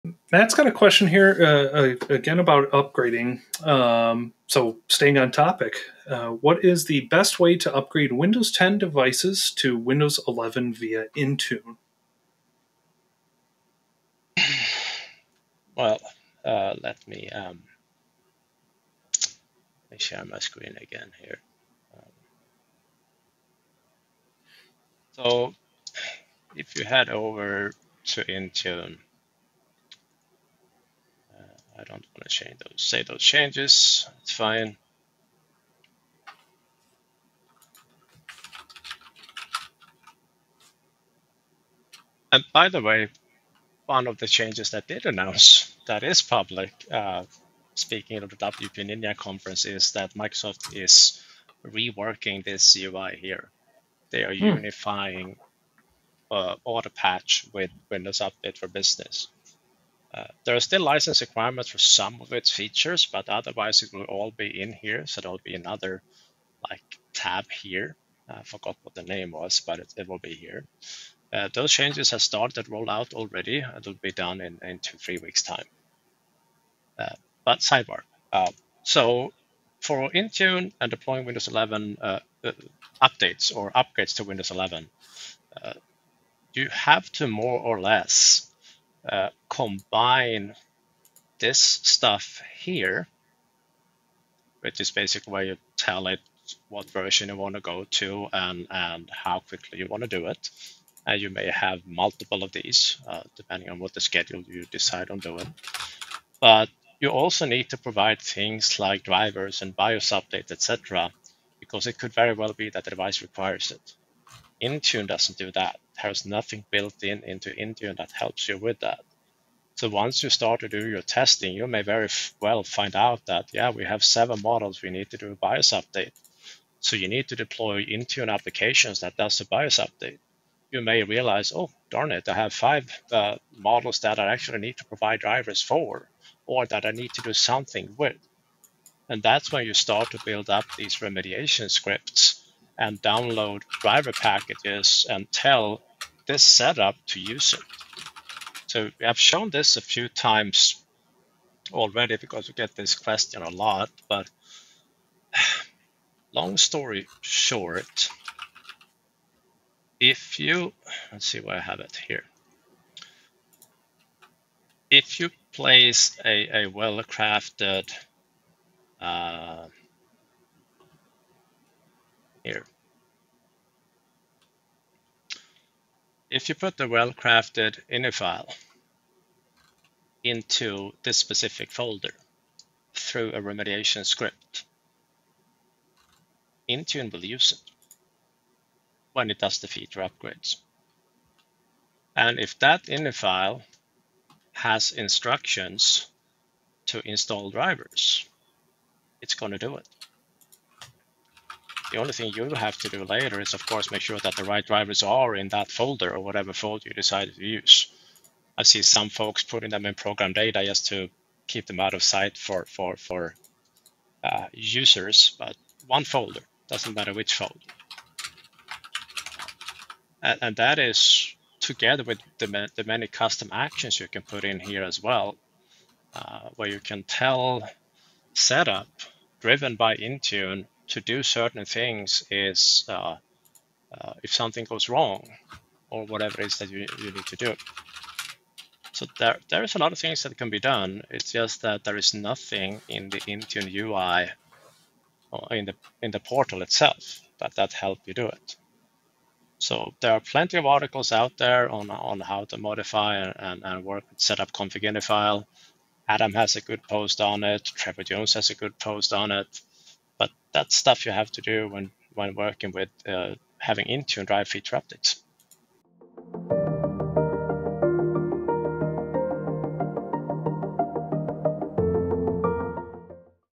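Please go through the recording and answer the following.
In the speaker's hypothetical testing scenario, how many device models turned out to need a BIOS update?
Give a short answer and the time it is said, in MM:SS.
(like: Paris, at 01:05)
7, at 02:04.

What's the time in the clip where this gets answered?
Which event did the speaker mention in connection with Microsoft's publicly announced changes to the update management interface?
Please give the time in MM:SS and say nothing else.
00:48.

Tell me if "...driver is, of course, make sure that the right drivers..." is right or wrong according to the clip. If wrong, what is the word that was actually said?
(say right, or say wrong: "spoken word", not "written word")
wrong: "later", not "driver".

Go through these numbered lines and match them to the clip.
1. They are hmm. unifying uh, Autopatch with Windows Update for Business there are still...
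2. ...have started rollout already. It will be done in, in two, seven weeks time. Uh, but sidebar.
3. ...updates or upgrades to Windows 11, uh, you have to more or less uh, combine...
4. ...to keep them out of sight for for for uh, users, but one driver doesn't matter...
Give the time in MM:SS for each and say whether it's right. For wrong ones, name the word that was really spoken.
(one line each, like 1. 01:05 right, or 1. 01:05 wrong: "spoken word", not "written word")
1. 00:54 right
2. 01:12 wrong: "three", not "seven"
3. 01:23 right
4. 03:30 wrong: "folder", not "driver".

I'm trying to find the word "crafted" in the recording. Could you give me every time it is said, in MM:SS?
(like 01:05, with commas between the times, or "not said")
02:46, 02:56.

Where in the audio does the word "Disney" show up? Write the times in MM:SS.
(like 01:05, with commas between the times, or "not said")
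not said.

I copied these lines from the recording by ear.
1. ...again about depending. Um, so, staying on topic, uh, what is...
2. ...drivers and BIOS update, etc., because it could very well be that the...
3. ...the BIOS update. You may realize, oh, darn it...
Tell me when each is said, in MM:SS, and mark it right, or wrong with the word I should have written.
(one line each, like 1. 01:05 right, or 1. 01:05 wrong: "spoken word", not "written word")
1. 00:02 wrong: "upgrading", not "depending"
2. 01:49 right
3. 02:09 right.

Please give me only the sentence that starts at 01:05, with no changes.
So there'll be another like tab here.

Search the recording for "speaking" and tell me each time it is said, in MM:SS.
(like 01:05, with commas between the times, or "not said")
00:47.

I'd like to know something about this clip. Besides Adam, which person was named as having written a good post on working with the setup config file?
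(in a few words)
Trevor Jones.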